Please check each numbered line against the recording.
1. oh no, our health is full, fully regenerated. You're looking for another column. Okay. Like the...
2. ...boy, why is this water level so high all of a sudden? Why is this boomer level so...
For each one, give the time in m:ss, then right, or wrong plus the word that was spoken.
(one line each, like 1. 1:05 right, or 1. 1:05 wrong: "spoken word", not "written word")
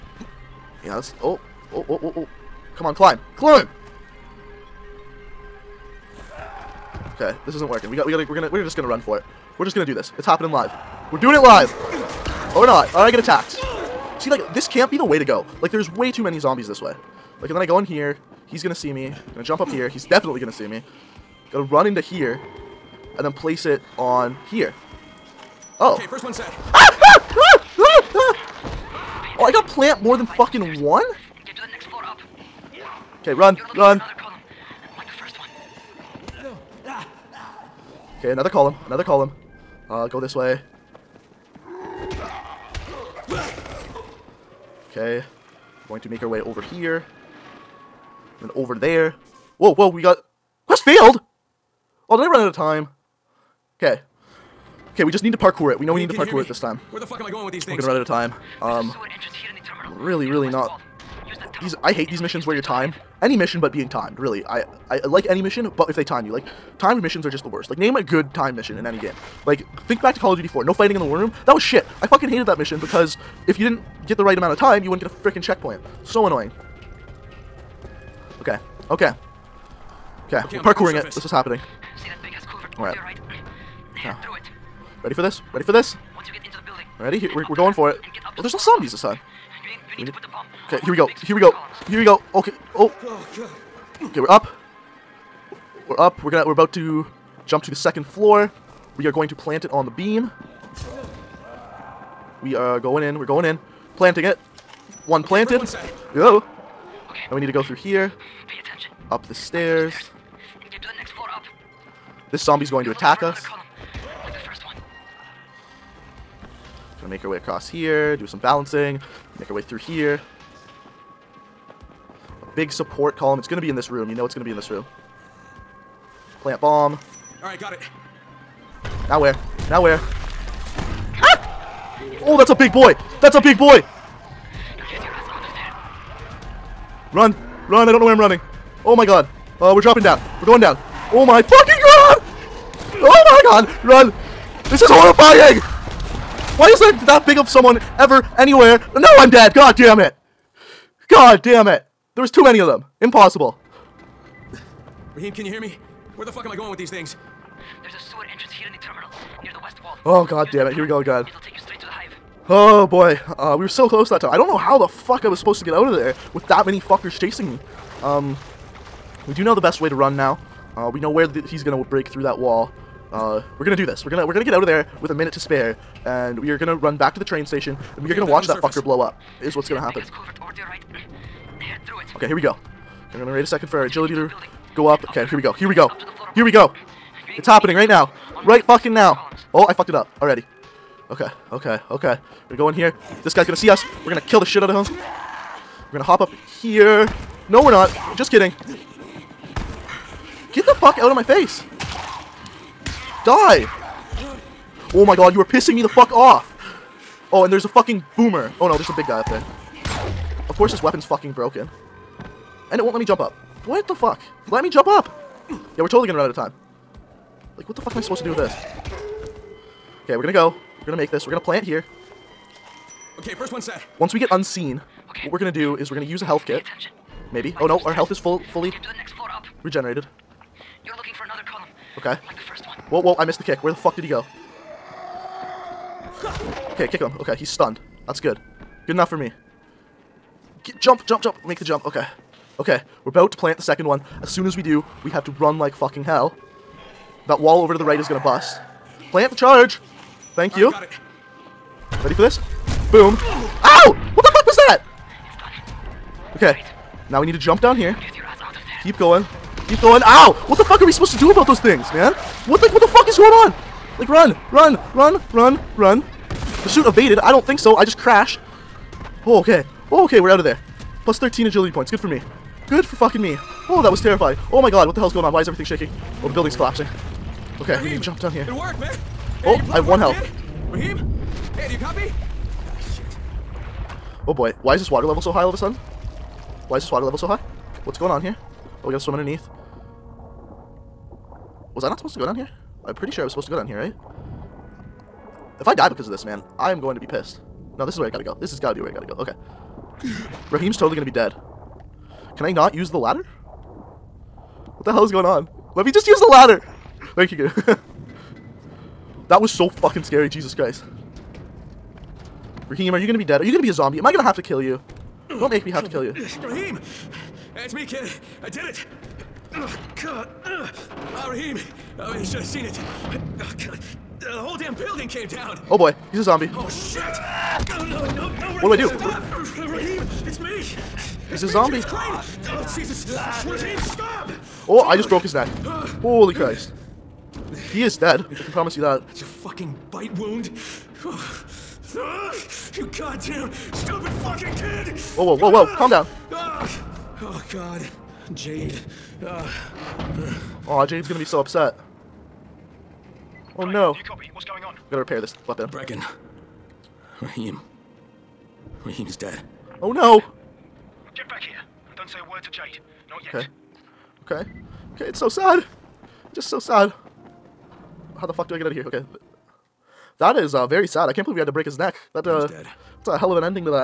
1. 3:47 right
2. 4:44 wrong: "water", not "boomer".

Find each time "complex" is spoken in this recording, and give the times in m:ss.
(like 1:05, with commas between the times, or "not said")
not said.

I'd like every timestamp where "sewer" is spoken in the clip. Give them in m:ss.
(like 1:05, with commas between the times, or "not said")
2:37.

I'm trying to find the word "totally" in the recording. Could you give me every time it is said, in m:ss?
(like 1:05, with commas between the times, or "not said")
3:35, 5:00.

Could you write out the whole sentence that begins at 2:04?
You know it's gonna be in this room.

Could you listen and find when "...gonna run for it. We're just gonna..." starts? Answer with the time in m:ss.
0:08.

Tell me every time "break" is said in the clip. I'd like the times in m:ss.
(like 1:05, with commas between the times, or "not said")
2:51, 6:11.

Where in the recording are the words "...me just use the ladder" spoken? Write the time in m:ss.
5:05.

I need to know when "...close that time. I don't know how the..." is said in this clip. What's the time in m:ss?
2:43.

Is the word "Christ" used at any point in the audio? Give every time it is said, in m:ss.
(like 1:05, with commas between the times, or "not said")
5:10, 5:36.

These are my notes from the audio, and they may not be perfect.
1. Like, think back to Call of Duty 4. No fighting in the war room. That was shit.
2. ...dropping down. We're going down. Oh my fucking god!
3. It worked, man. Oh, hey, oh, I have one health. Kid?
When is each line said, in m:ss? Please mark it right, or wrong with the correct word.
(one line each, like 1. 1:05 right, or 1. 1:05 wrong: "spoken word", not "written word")
1. 1:09 right
2. 2:19 right
3. 4:38 right.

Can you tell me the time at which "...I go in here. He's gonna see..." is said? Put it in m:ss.
0:17.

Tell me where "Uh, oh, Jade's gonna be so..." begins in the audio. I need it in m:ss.
5:49.